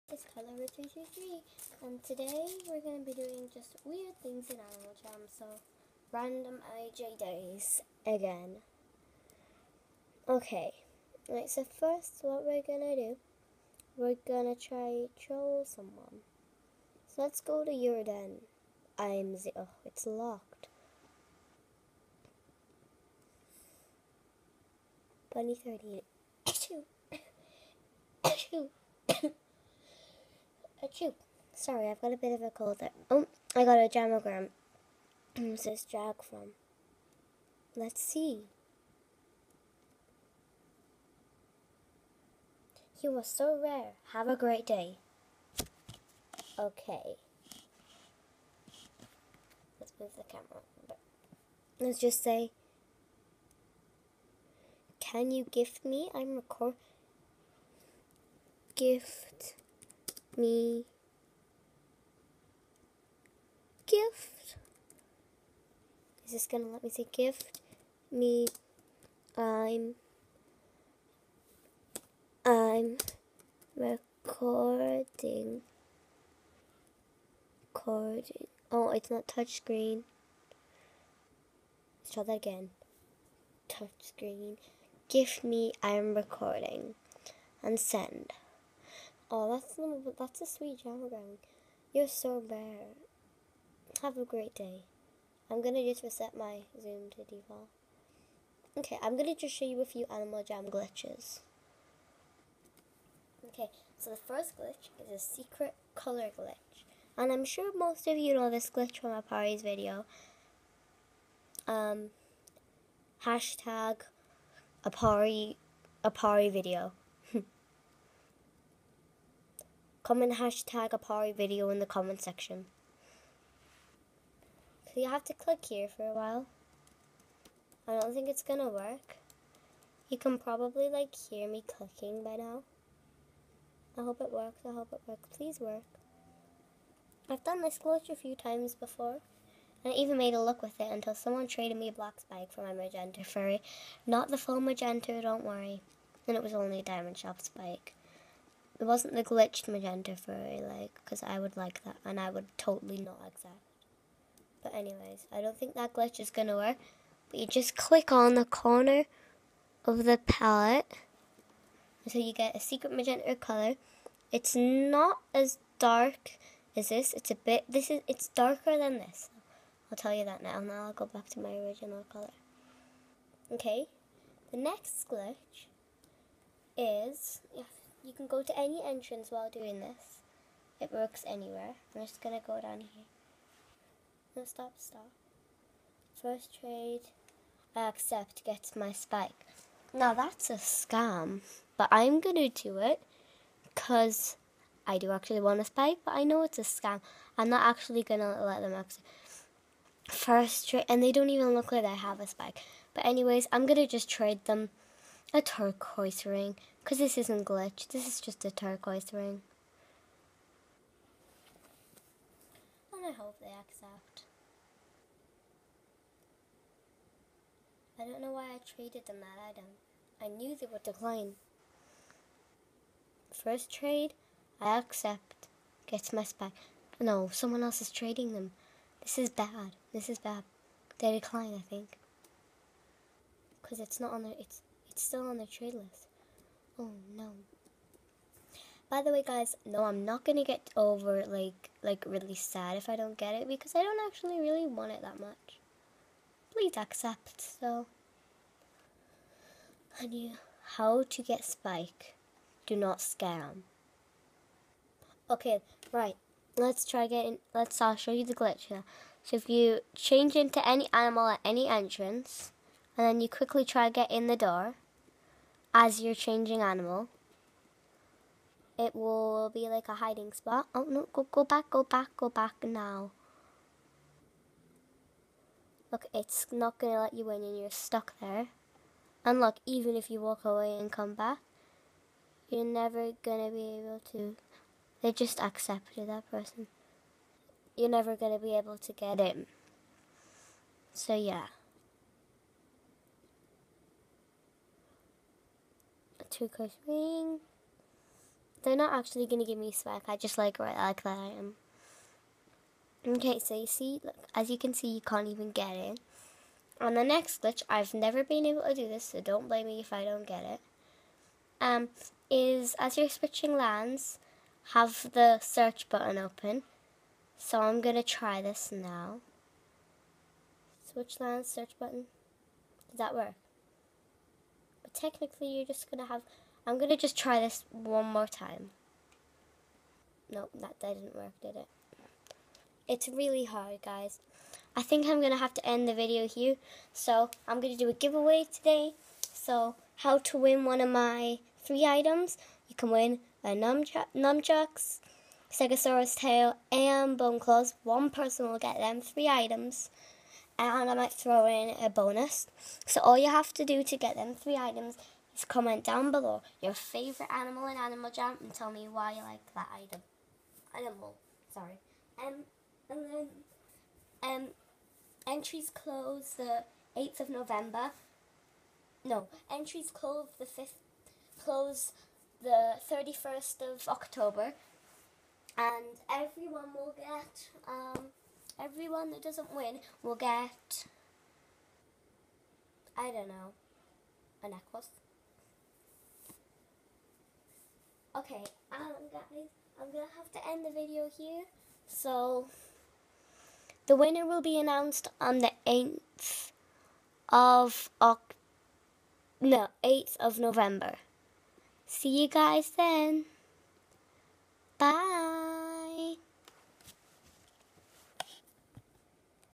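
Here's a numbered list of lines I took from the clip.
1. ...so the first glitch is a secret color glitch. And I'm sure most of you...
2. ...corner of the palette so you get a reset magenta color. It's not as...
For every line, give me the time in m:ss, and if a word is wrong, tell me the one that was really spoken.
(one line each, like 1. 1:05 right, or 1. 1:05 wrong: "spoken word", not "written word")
1. 1:43 right
2. 2:38 wrong: "secret", not "reset".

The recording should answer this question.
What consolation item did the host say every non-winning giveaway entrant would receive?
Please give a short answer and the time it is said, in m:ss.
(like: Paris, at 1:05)
A necklace, at 6:24.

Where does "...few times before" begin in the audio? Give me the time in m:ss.
2:18.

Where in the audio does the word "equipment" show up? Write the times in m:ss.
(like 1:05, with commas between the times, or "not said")
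not said.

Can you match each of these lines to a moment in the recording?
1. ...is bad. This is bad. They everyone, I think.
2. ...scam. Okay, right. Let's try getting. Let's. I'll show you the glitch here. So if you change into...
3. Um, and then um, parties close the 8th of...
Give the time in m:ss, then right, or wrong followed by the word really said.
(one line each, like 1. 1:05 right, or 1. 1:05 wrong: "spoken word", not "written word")
1. 3:49 wrong: "decline", not "everyone"
2. 4:12 right
3. 6:02 wrong: "entries", not "parties".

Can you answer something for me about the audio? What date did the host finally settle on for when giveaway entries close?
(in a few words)
31st of October.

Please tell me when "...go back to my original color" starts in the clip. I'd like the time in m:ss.
2:50.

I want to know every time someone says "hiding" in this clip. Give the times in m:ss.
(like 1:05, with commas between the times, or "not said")
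4:29.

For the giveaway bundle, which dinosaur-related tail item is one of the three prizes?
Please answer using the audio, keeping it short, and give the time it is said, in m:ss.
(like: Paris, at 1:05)
Stegosaurus tail, at 5:45.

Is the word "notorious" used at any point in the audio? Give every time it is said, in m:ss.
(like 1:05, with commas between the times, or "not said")
not said.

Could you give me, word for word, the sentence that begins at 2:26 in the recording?
And it was only a diamond shop spike.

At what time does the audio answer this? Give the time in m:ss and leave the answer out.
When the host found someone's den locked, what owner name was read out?
0:25.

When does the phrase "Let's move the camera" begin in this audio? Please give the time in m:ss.
0:49.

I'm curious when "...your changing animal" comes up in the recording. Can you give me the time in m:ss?
4:26.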